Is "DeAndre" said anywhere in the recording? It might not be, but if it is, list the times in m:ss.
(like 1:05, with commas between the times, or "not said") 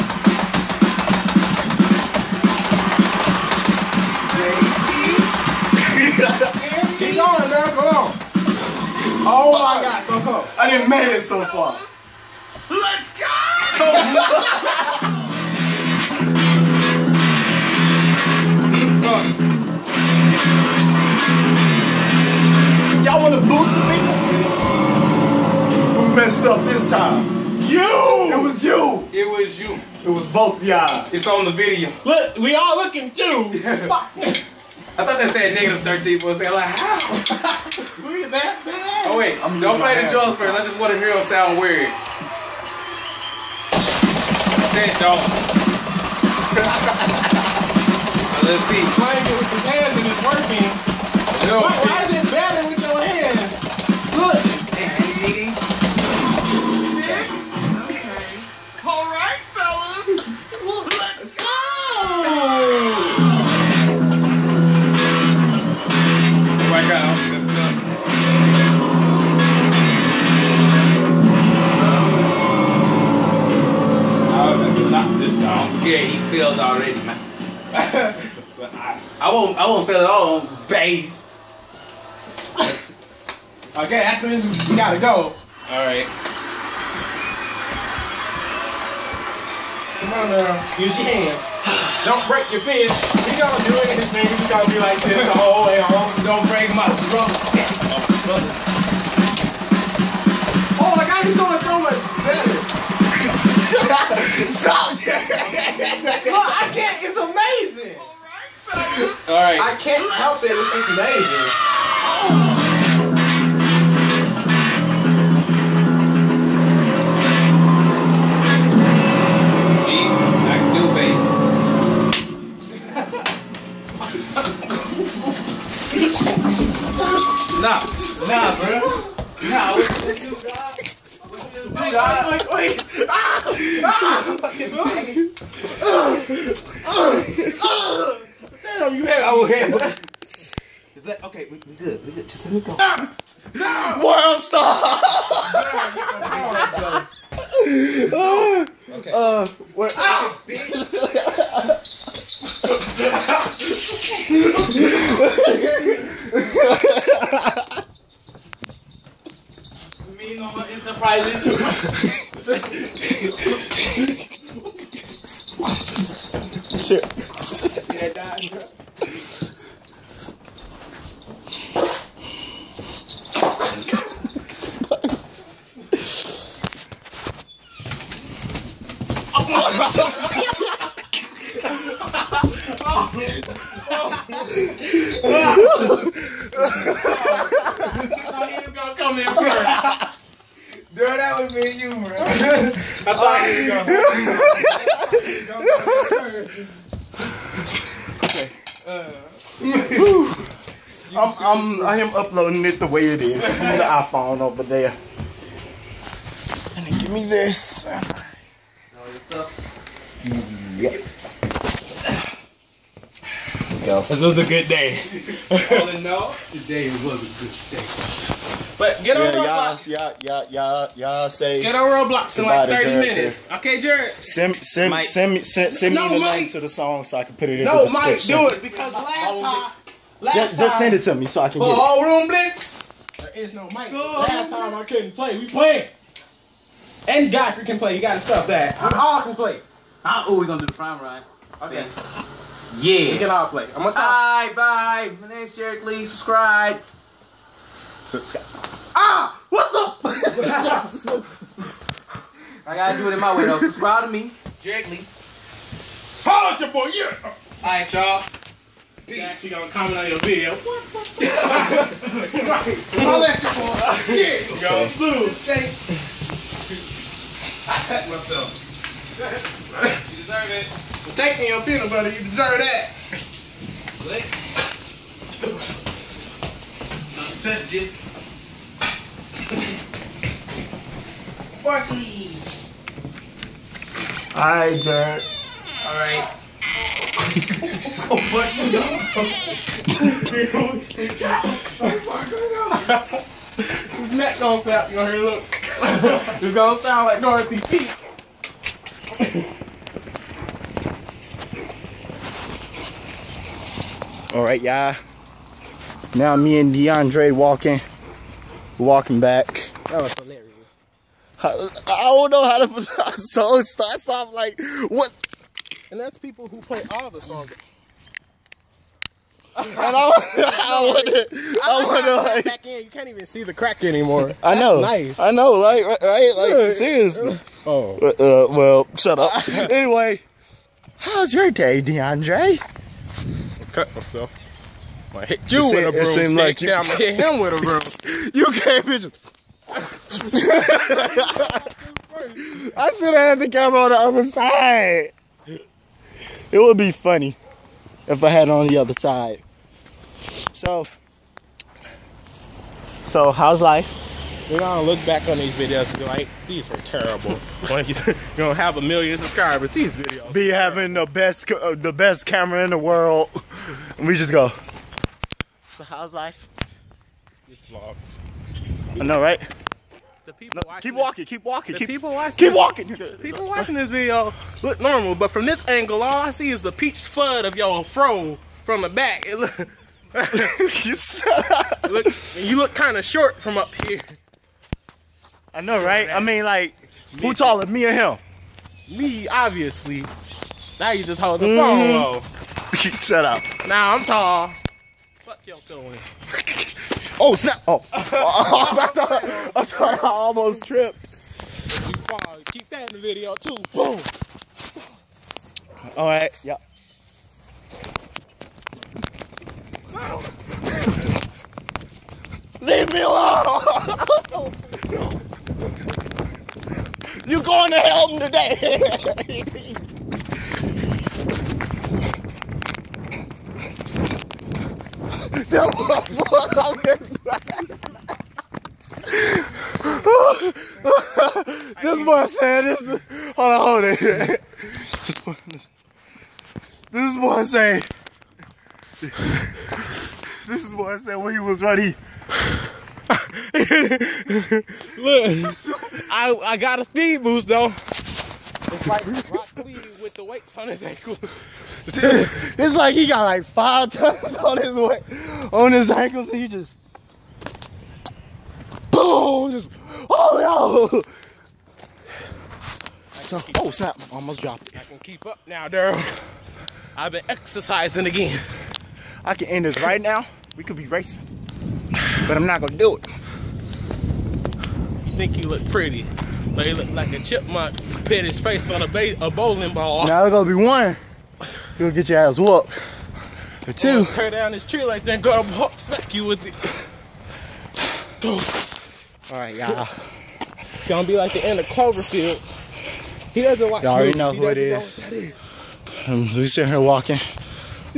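5:06, 5:31.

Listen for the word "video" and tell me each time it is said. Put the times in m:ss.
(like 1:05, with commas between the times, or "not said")
0:31, 4:20, 5:55, 5:59, 6:13, 6:43.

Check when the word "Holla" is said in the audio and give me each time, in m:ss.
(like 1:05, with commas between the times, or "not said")
4:16, 4:23.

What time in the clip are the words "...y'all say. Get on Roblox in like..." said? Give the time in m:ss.
3:40.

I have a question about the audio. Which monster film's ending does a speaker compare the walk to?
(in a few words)
Cloverfield.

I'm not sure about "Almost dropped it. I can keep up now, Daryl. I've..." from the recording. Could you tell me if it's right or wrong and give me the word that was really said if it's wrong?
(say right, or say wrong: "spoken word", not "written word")
right.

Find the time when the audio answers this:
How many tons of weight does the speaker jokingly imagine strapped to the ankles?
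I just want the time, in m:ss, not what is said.
7:33.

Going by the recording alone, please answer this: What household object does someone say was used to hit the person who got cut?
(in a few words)
A broomstick.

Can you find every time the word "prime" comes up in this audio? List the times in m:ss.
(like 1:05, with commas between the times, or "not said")
4:00.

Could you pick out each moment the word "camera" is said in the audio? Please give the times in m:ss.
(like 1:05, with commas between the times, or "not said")
5:43, 6:02.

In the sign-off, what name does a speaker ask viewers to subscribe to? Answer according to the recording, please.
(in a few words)
Jiggly.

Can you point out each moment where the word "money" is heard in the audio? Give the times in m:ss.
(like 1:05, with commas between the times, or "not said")
not said.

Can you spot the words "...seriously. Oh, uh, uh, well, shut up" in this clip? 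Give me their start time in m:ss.
5:26.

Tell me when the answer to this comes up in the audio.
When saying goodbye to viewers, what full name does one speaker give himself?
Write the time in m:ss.
4:05.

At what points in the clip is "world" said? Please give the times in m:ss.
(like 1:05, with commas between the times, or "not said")
2:24, 6:02.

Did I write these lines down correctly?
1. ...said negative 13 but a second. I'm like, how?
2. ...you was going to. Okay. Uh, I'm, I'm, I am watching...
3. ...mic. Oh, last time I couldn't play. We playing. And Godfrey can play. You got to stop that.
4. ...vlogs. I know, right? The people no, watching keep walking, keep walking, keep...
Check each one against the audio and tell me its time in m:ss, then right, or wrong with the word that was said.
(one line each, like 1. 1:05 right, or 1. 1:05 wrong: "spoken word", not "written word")
1. 0:35 right
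2. 3:16 wrong: "uploading", not "watching"
3. 3:53 right
4. 6:07 right.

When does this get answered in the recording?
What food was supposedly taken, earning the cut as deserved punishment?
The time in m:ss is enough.
4:31.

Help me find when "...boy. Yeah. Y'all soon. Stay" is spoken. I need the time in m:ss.
4:23.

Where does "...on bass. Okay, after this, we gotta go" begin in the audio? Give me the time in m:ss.
1:20.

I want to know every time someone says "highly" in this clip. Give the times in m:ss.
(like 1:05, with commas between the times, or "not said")
not said.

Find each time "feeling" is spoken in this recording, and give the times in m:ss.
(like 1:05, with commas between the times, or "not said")
6:35.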